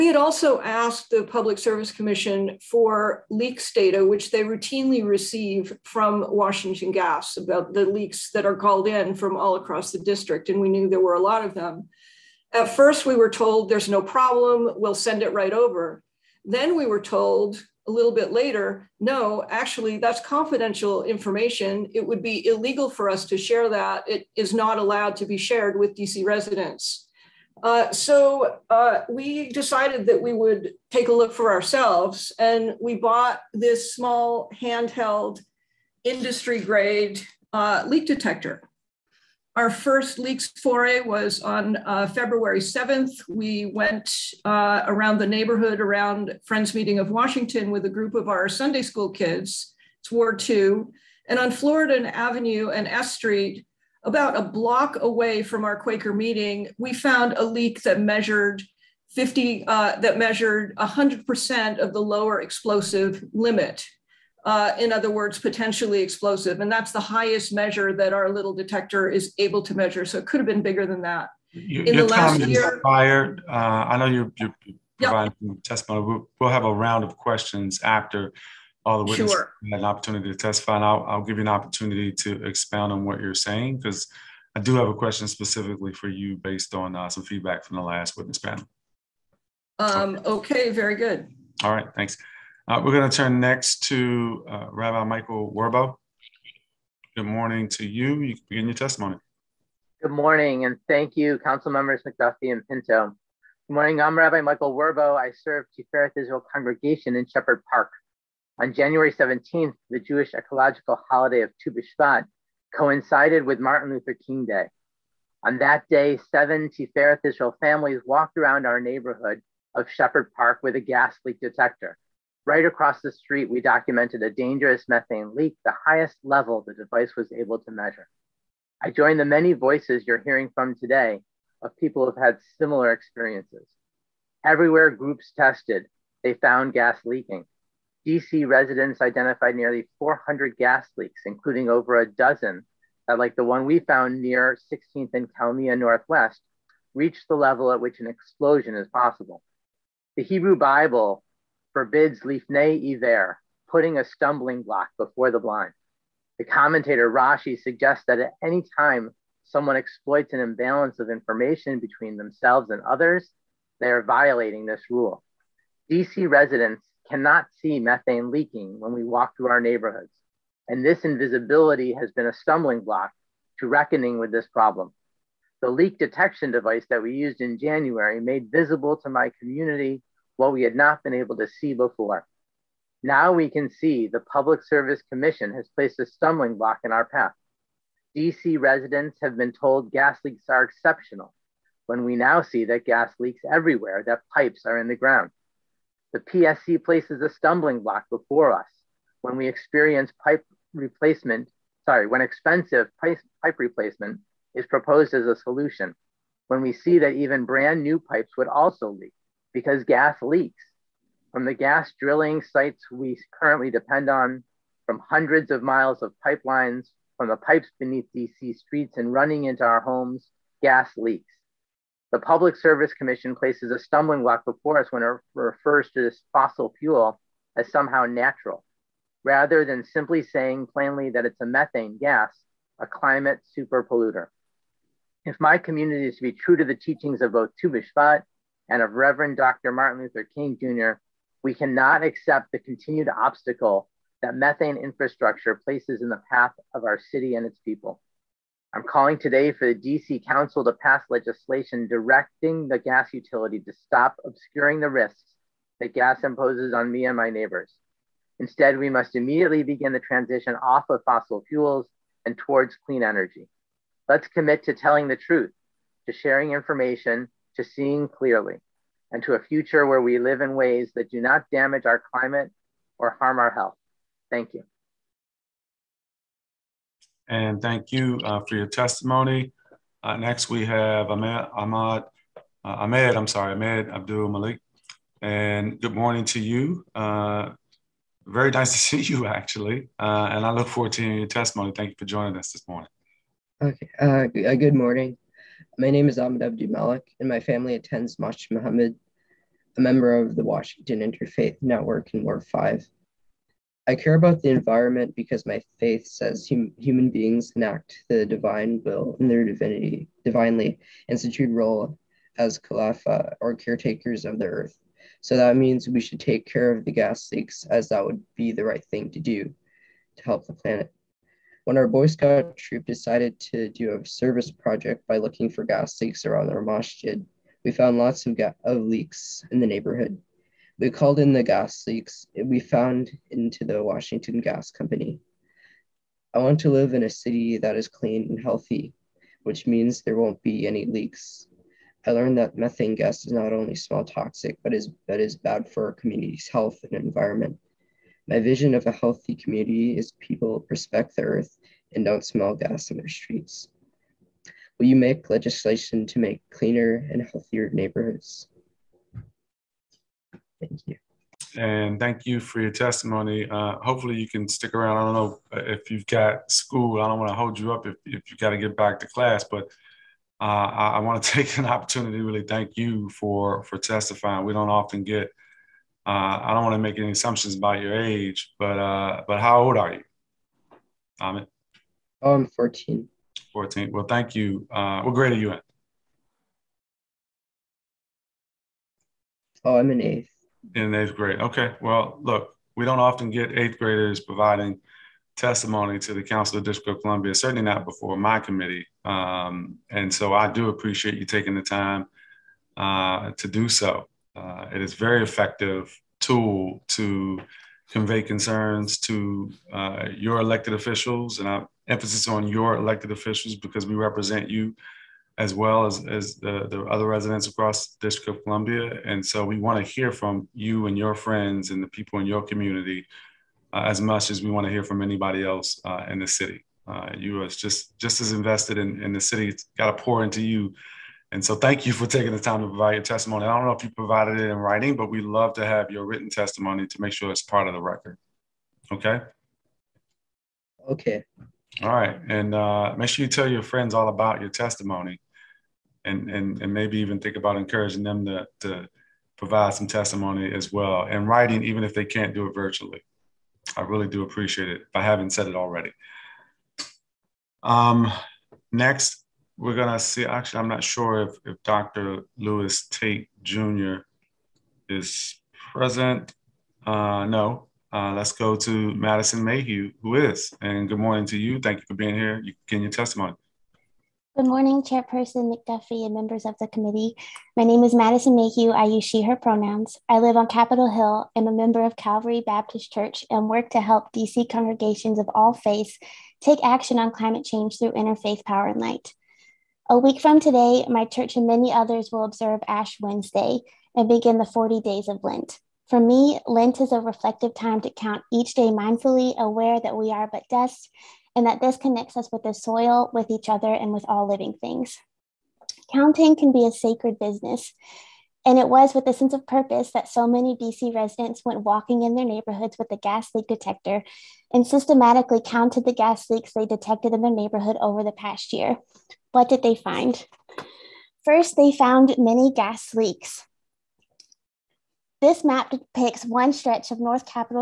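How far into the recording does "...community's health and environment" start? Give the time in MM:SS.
05:45.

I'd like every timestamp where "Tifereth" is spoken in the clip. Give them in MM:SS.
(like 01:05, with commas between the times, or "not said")
01:45, 01:56.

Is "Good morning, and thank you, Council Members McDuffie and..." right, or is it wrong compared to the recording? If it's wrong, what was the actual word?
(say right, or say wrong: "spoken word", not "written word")
right.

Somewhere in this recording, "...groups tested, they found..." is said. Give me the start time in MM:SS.
02:14.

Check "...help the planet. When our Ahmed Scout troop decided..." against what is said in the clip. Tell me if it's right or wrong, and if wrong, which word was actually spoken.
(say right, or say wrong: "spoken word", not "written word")
wrong: "Boy", not "Ahmed".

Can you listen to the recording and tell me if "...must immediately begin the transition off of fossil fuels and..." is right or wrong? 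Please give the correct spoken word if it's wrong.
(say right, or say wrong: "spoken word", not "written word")
right.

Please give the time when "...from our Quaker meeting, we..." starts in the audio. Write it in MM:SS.
00:55.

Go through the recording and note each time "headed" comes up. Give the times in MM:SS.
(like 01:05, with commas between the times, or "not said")
not said.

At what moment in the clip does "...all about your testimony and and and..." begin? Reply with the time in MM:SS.
07:23.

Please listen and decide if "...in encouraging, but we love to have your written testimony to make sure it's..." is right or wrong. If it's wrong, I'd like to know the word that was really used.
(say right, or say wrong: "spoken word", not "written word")
wrong: "writing", not "encouraging".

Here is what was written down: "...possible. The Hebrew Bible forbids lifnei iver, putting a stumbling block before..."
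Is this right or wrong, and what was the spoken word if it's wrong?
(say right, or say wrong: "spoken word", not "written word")
right.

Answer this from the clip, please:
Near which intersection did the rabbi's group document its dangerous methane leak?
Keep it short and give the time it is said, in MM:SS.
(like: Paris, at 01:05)
16th and Kalmia Northwest, at 02:24.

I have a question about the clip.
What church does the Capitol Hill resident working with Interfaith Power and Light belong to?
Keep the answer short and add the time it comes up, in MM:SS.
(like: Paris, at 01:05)
Calvary Baptist Church, at 08:01.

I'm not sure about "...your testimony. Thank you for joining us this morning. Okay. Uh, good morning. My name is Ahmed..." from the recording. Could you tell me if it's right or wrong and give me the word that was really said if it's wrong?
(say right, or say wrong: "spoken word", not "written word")
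right.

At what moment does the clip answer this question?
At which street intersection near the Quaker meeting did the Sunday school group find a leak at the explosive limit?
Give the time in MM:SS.
00:51.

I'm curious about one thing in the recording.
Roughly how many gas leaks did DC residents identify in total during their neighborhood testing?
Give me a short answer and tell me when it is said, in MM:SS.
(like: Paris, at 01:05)
400, at 02:19.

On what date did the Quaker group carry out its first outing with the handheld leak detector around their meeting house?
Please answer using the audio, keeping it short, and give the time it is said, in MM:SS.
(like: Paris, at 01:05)
February 7, at 00:42.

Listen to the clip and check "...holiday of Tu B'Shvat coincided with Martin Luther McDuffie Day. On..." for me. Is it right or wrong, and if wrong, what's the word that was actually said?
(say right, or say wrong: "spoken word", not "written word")
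wrong: "King", not "McDuffie".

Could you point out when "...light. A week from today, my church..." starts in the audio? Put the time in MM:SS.
08:08.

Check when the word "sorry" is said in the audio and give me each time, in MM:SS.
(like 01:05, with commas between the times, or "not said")
03:21, 04:43.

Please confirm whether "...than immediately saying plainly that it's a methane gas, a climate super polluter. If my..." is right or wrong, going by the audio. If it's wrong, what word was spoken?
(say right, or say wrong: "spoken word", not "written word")
wrong: "simply", not "immediately".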